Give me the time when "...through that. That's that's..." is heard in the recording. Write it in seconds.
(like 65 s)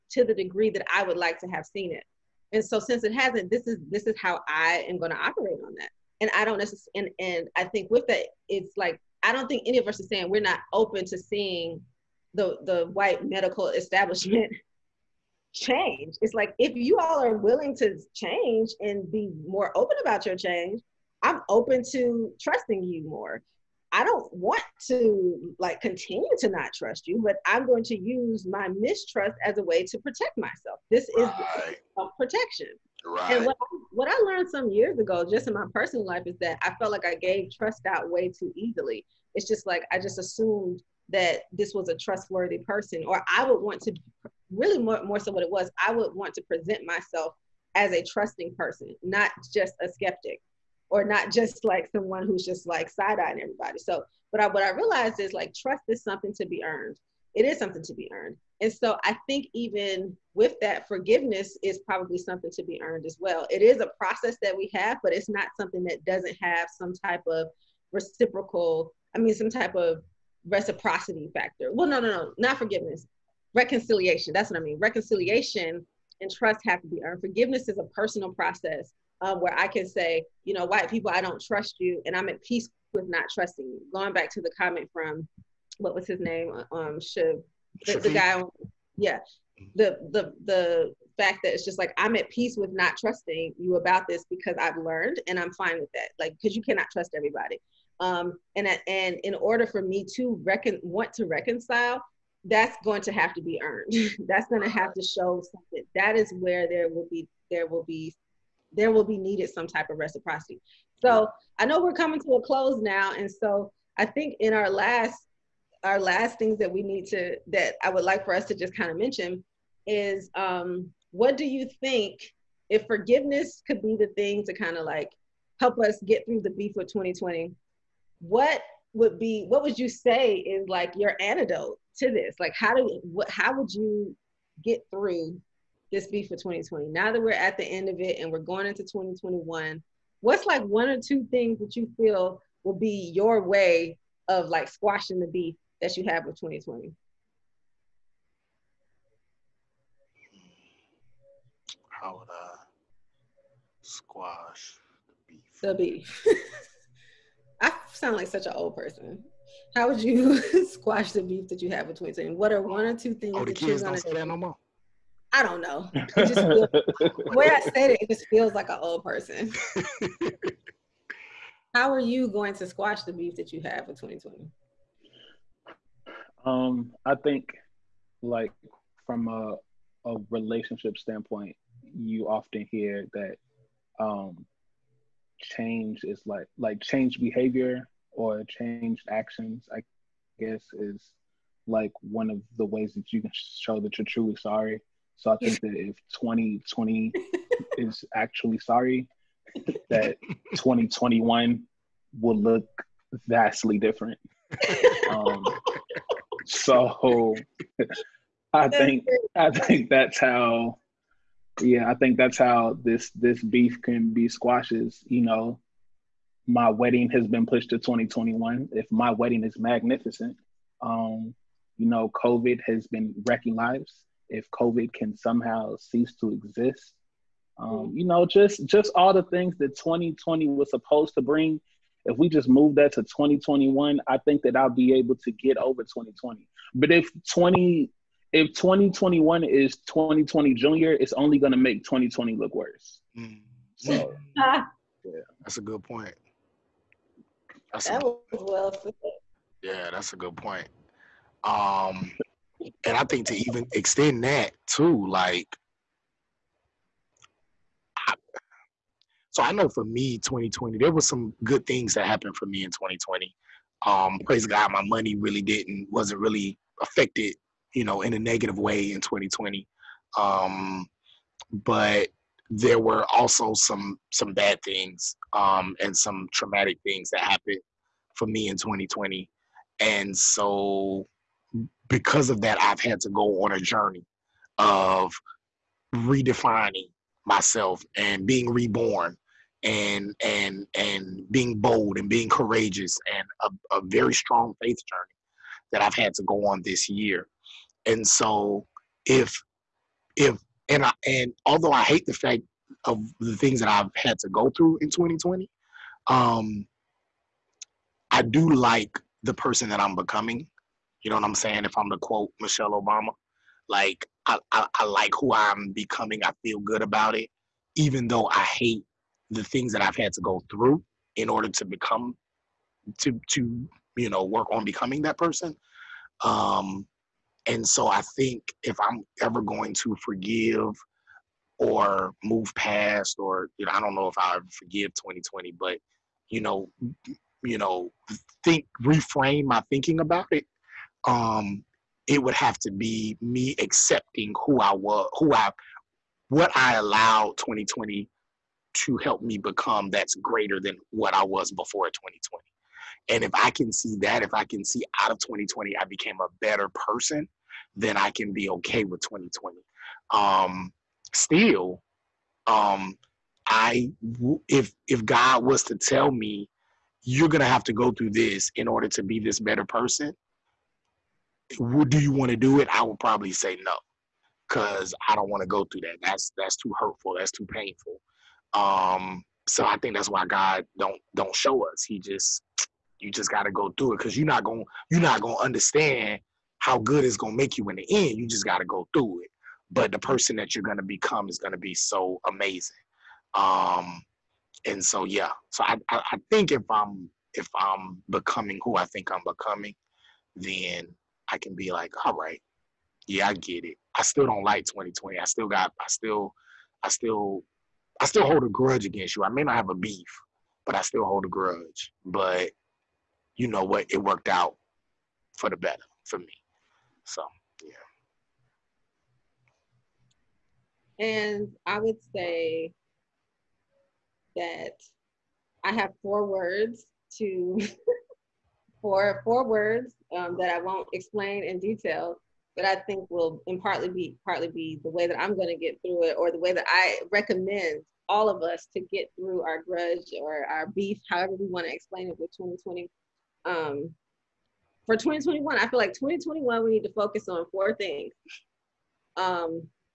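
375 s.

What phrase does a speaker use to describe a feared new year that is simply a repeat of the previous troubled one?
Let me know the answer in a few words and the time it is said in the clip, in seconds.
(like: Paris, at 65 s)
2020 junior, at 239 s.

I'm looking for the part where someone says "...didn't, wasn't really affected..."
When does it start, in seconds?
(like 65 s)
265 s.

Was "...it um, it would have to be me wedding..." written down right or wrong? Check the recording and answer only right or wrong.
wrong.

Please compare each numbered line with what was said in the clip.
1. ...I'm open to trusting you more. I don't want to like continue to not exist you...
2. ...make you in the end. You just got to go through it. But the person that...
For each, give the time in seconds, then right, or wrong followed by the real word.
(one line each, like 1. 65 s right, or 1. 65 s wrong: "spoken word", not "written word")
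1. 21 s wrong: "trust", not "exist"
2. 387 s right.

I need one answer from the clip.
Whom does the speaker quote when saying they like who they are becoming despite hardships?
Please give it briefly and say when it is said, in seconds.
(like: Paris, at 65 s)
Michelle Obama, at 312 s.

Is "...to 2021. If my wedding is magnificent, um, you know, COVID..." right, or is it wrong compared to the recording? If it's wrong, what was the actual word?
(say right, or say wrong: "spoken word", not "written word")
right.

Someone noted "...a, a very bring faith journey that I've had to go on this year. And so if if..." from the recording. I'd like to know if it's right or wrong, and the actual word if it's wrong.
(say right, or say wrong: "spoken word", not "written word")
wrong: "strong", not "bring".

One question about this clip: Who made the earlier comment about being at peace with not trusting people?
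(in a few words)
Shiv.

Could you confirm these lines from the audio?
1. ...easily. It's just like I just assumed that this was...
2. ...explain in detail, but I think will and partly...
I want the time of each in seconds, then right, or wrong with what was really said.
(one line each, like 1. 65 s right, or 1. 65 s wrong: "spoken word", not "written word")
1. 38 s right
2. 430 s right.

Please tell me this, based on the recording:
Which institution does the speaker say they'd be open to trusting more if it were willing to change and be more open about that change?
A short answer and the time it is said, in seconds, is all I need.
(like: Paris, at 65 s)
white medical establishment, at 12 s.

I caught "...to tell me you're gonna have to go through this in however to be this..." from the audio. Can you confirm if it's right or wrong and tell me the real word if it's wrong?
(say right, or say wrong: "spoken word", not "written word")
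wrong: "order", not "however".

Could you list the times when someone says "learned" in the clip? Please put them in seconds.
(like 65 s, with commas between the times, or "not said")
34 s, 94 s.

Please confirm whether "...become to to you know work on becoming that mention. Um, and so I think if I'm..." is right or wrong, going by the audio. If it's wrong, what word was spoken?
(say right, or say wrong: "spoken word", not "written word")
wrong: "person", not "mention".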